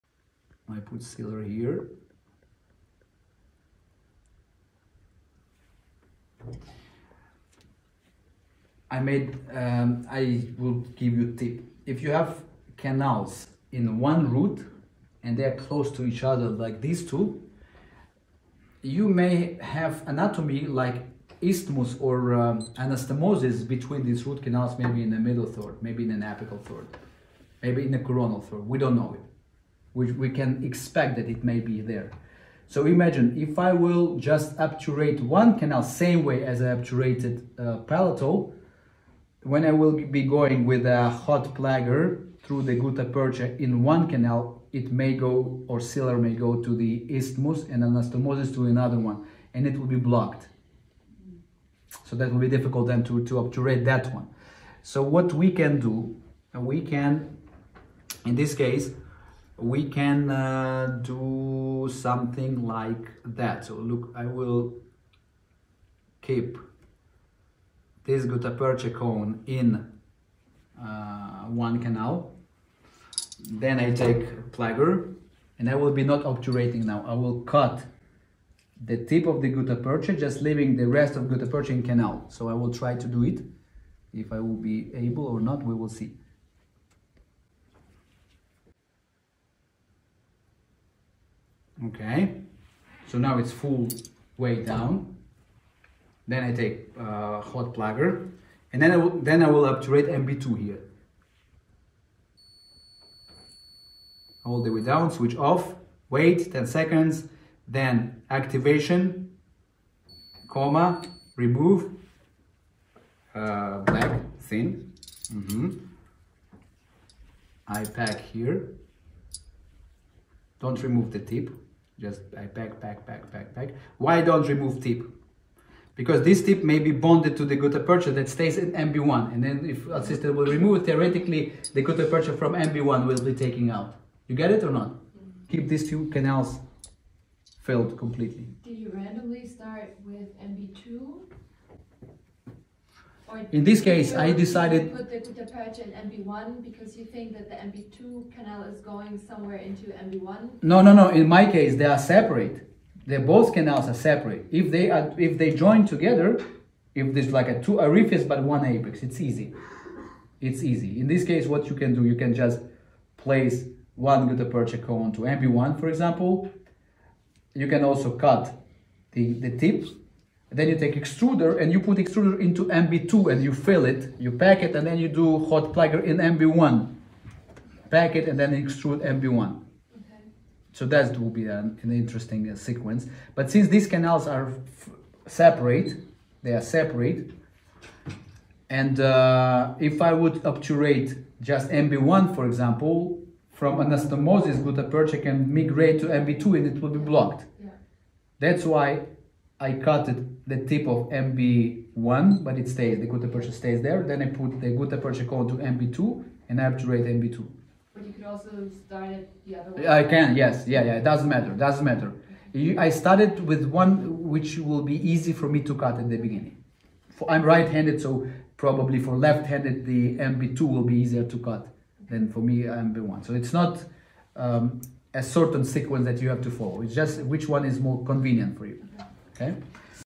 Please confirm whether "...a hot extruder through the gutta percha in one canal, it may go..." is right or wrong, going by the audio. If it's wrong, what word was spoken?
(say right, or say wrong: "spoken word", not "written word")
wrong: "plugger", not "extruder".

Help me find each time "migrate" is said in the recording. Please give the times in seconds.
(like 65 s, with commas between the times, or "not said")
195 s.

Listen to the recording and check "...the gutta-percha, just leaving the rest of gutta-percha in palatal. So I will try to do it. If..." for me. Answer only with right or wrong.
wrong.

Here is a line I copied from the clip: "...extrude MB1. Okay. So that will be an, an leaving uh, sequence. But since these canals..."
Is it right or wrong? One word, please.
wrong.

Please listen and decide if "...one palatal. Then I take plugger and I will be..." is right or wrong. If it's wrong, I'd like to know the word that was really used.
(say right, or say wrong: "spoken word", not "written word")
wrong: "canal", not "palatal".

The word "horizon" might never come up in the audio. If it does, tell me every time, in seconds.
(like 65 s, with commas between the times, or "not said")
not said.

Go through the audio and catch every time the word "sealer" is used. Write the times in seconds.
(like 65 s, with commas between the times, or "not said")
1 s, 45 s.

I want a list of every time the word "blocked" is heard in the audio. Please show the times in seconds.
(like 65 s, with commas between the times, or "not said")
49 s, 196 s.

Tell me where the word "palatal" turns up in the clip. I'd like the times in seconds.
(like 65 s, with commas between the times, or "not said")
37 s.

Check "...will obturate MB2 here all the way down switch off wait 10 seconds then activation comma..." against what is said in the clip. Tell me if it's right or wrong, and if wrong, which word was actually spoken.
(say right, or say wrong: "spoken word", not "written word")
right.